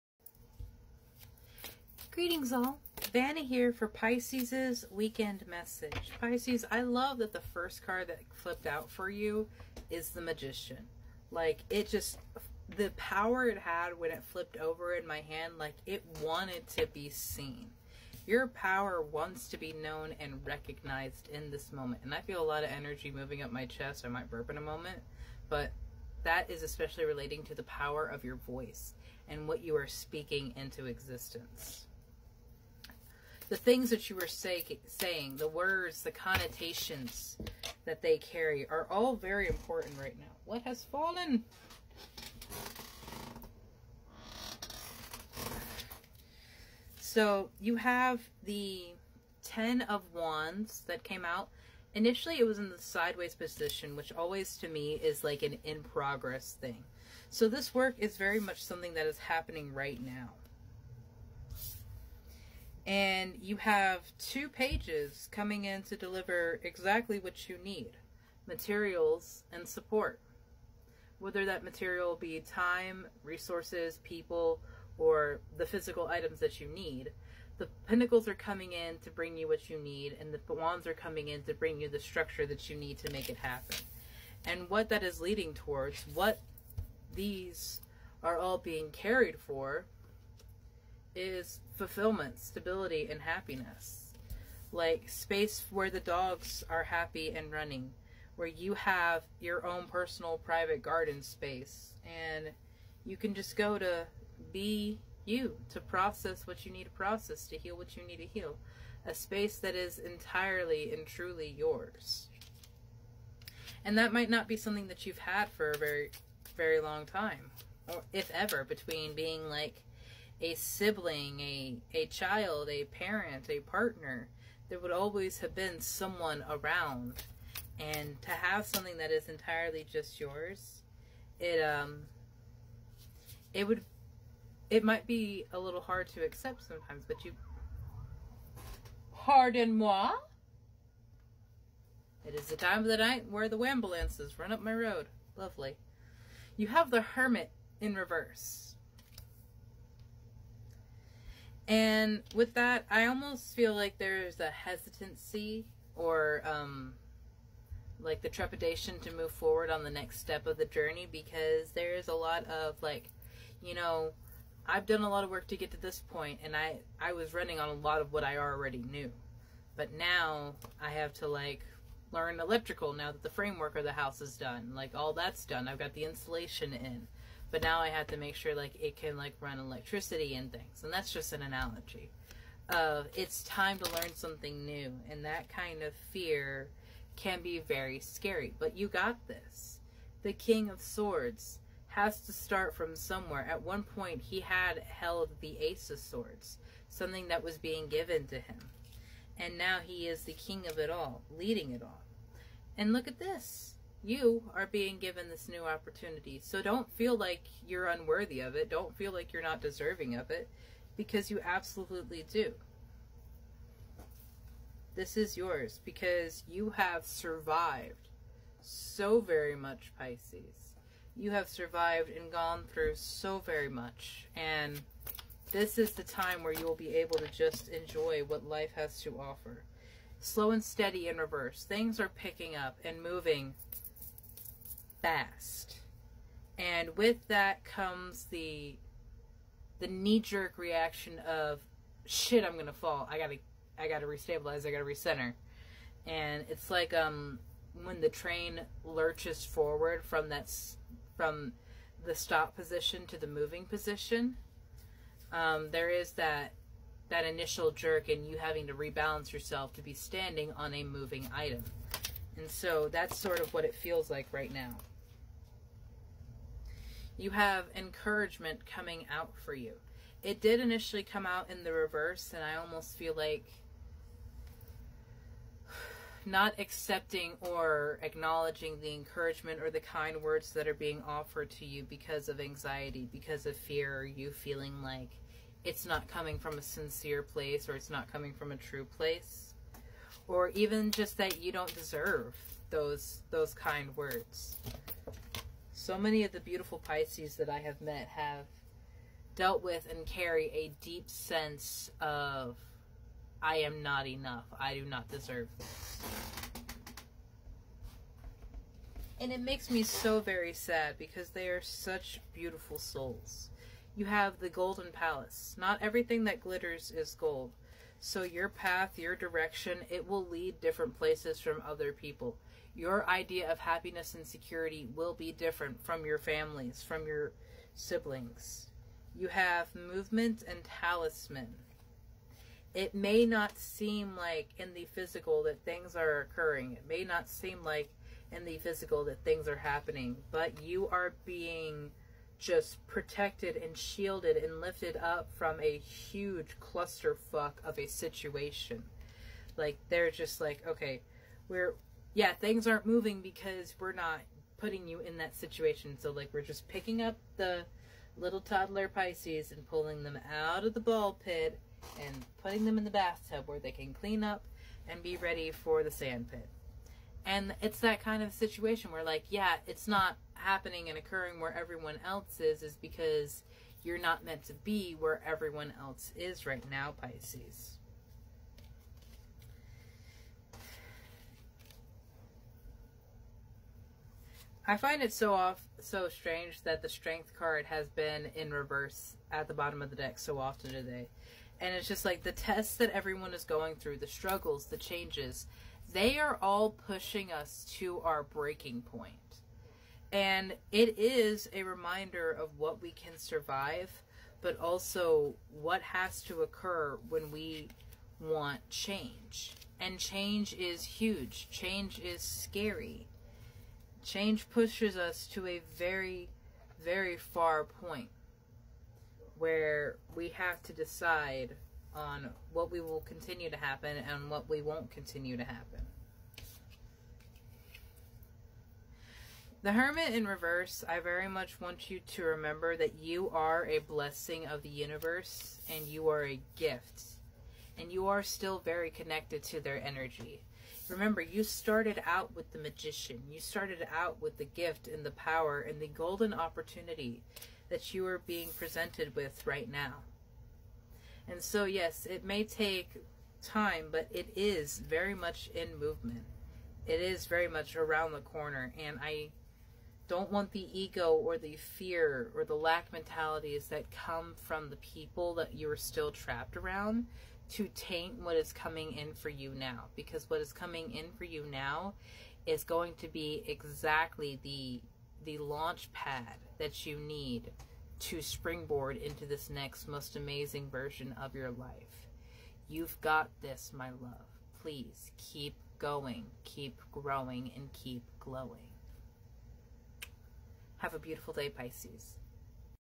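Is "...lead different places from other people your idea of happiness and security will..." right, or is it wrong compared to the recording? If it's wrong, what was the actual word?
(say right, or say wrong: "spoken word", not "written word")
right.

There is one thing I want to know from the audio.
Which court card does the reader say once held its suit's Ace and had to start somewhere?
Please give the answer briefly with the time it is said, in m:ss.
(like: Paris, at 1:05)
King of Swords, at 3:10.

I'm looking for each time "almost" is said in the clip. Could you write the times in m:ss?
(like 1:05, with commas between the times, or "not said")
2:33, 4:32.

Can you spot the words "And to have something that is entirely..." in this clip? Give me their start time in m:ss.
2:07.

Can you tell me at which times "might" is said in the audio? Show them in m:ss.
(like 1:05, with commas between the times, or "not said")
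0:24, 1:54, 2:14.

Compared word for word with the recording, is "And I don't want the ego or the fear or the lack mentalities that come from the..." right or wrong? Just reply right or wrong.
right.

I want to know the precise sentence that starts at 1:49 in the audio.
A space that is entirely and truly yours.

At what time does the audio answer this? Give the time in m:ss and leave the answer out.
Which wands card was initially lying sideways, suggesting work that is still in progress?
0:49.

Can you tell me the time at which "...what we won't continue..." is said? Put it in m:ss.
7:04.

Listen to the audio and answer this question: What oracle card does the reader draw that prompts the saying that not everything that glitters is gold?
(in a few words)
The Golden Palace.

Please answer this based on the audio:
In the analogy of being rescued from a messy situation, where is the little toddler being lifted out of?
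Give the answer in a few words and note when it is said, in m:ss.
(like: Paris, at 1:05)
The ball pit, at 6:00.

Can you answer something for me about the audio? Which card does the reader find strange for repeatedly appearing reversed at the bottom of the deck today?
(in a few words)
Strength.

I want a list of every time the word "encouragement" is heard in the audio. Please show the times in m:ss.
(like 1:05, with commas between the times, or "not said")
4:27, 4:38.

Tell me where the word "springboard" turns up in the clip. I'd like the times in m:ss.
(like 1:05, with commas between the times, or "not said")
7:58.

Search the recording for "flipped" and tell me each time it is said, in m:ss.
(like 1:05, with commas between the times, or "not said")
0:08, 0:14.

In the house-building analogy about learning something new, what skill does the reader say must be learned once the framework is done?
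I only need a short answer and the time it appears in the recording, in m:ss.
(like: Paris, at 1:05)
Electrical, at 2:52.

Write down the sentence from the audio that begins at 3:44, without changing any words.
And this is the time where you will be able to just enjoy what life has to offer.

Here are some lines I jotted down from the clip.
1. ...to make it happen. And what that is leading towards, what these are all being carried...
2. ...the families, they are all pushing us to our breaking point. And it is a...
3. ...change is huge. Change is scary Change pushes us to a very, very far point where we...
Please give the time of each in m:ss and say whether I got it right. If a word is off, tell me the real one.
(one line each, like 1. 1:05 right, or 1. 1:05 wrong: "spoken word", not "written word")
1. 1:22 right
2. 6:34 wrong: "changes", not "families"
3. 6:49 right.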